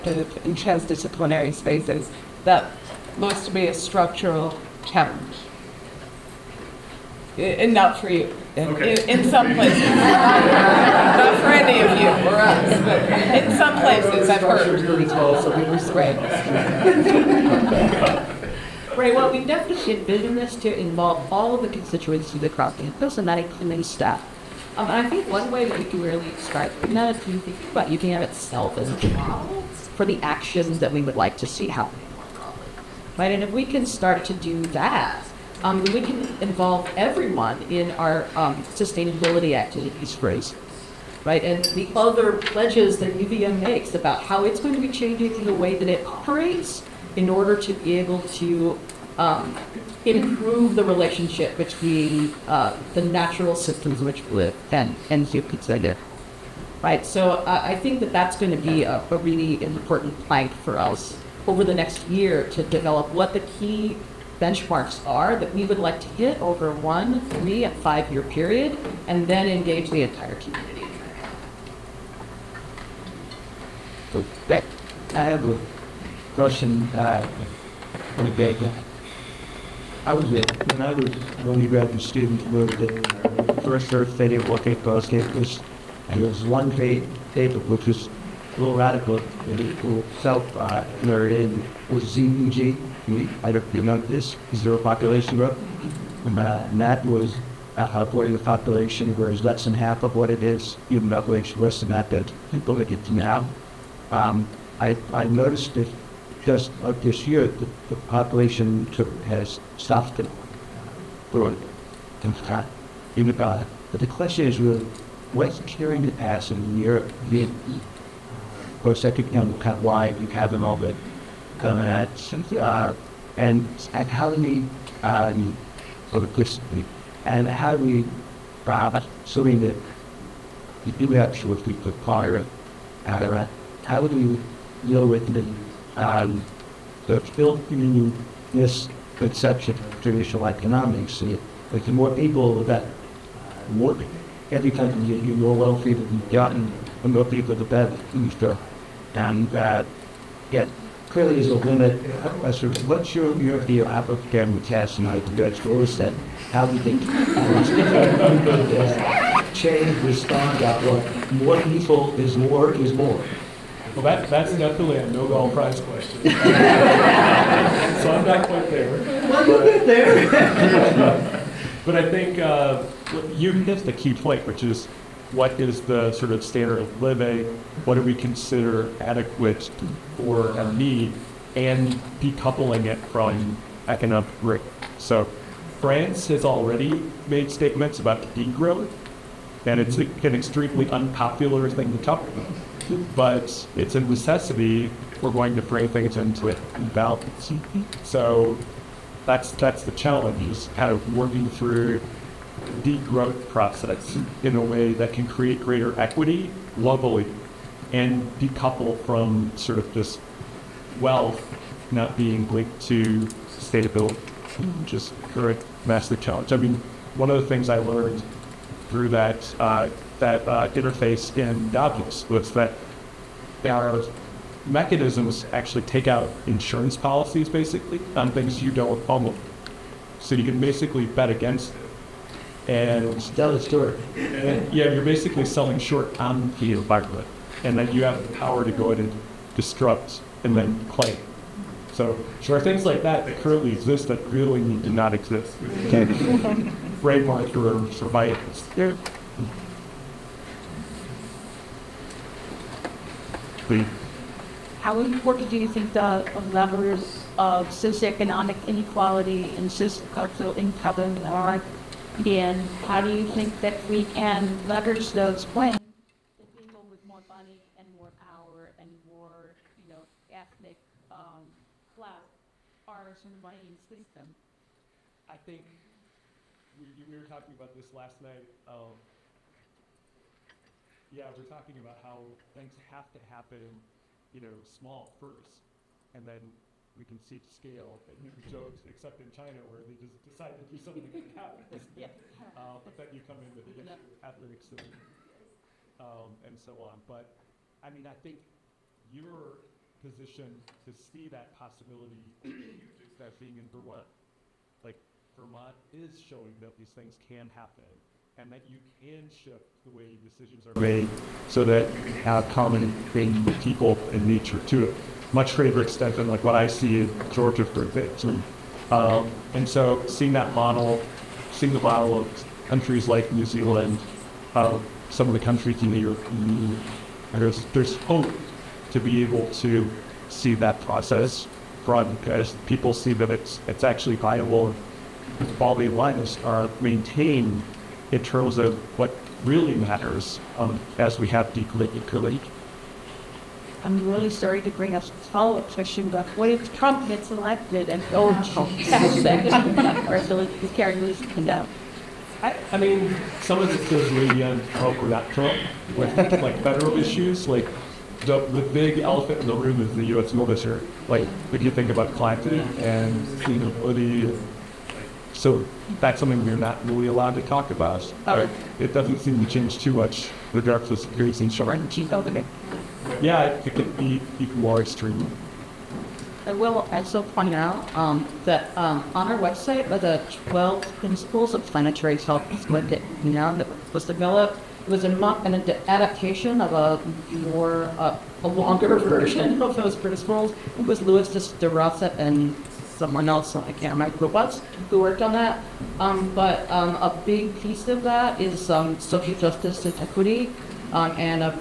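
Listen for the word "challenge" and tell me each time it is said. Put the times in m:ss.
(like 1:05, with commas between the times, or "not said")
0:04, 3:19, 3:36.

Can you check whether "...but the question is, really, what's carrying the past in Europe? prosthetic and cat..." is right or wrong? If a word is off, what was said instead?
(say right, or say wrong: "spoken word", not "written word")
right.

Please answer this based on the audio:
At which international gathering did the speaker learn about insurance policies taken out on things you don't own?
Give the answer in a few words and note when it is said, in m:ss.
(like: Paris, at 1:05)
Davos, at 3:41.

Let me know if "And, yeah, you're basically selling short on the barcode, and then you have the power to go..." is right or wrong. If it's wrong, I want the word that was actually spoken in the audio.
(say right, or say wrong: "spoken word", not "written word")
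right.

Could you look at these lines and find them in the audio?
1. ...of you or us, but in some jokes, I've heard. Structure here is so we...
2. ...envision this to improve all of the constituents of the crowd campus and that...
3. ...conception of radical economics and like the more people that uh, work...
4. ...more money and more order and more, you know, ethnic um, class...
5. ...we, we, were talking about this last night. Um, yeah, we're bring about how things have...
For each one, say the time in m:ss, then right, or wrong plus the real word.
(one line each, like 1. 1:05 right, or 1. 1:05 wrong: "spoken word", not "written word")
1. 0:11 wrong: "places", not "jokes"
2. 0:19 wrong: "involve", not "improve"
3. 2:19 wrong: "traditional", not "radical"
4. 4:27 wrong: "power", not "order"
5. 4:36 wrong: "talking", not "bring".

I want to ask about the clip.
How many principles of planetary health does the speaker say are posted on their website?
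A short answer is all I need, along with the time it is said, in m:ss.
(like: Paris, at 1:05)
12, at 6:20.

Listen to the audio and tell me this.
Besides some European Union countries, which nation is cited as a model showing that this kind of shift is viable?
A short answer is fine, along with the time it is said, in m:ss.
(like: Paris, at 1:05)
New Zealand, at 5:23.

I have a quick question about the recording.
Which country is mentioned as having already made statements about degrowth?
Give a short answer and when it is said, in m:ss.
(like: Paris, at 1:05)
France, at 3:05.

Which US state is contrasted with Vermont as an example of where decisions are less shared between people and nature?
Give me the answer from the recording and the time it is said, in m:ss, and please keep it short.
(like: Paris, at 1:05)
Georgia, at 5:17.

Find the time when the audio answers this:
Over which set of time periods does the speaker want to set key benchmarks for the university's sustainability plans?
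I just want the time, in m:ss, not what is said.
1:06.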